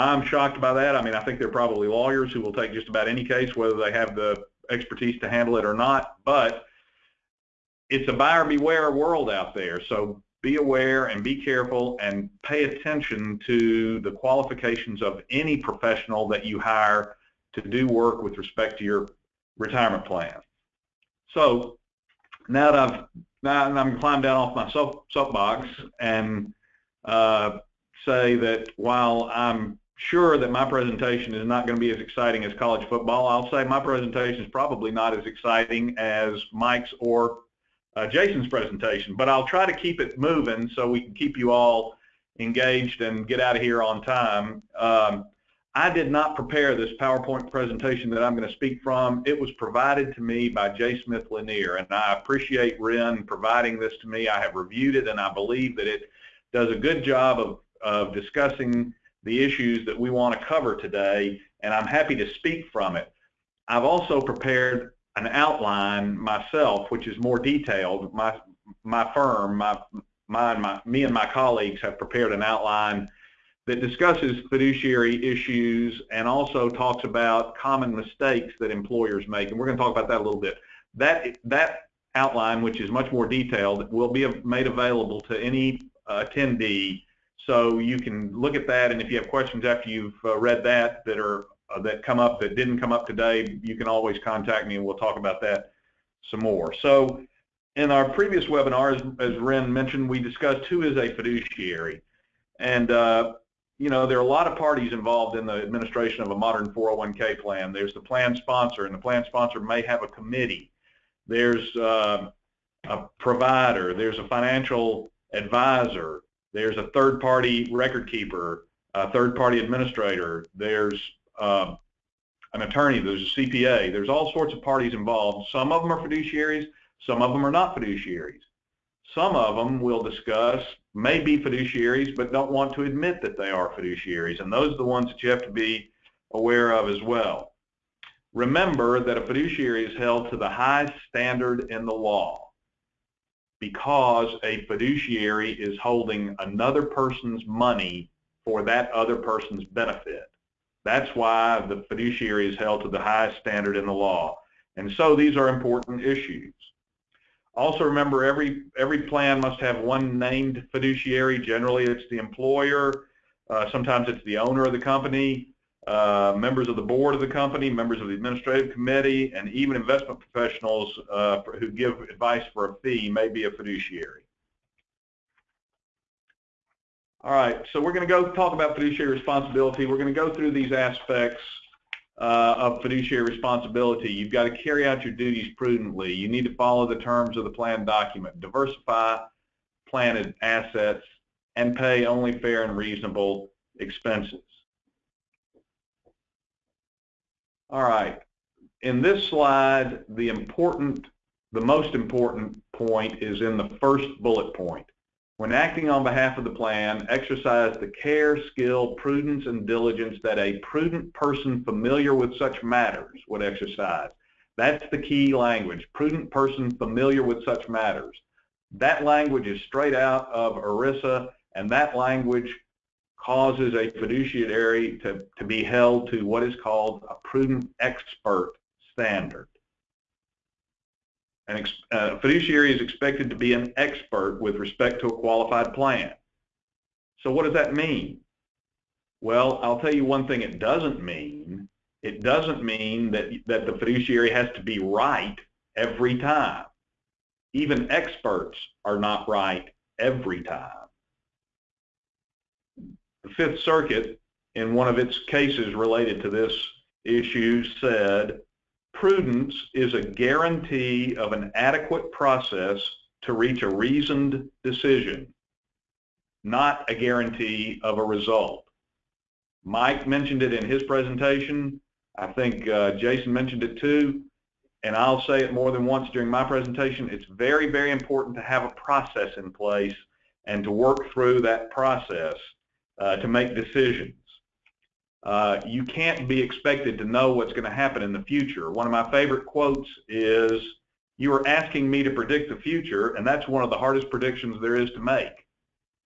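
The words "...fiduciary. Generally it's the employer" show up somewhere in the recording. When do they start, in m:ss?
2:40.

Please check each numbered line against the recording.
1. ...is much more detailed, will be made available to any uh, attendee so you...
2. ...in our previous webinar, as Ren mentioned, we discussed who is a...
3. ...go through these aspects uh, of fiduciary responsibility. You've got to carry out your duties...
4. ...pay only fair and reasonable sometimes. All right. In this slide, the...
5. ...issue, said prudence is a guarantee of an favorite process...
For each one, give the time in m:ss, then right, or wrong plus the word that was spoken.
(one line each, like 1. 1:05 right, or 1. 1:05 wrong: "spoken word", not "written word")
1. 1:22 right
2. 1:37 right
3. 3:00 right
4. 3:11 wrong: "expenses", not "sometimes"
5. 4:17 wrong: "adequate", not "favorite".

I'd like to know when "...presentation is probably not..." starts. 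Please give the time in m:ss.
0:33.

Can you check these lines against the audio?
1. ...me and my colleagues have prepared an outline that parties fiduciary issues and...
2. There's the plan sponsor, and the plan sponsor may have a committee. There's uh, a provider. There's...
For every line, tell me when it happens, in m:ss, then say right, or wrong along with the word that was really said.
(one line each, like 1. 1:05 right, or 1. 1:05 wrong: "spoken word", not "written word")
1. 1:10 wrong: "discusses", not "parties"
2. 1:47 right.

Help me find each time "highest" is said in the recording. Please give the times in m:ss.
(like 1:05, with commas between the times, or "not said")
2:20, 2:32.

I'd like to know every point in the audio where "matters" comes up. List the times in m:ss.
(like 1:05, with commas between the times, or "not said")
3:32, 3:37.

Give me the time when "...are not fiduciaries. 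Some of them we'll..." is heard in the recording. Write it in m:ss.
2:07.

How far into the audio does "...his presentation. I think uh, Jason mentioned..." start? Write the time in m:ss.
4:30.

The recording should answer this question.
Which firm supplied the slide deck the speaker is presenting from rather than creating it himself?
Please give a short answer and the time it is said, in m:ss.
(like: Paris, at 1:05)
J. Smith Lanier, at 0:50.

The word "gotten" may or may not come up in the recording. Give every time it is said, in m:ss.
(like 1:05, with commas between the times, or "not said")
not said.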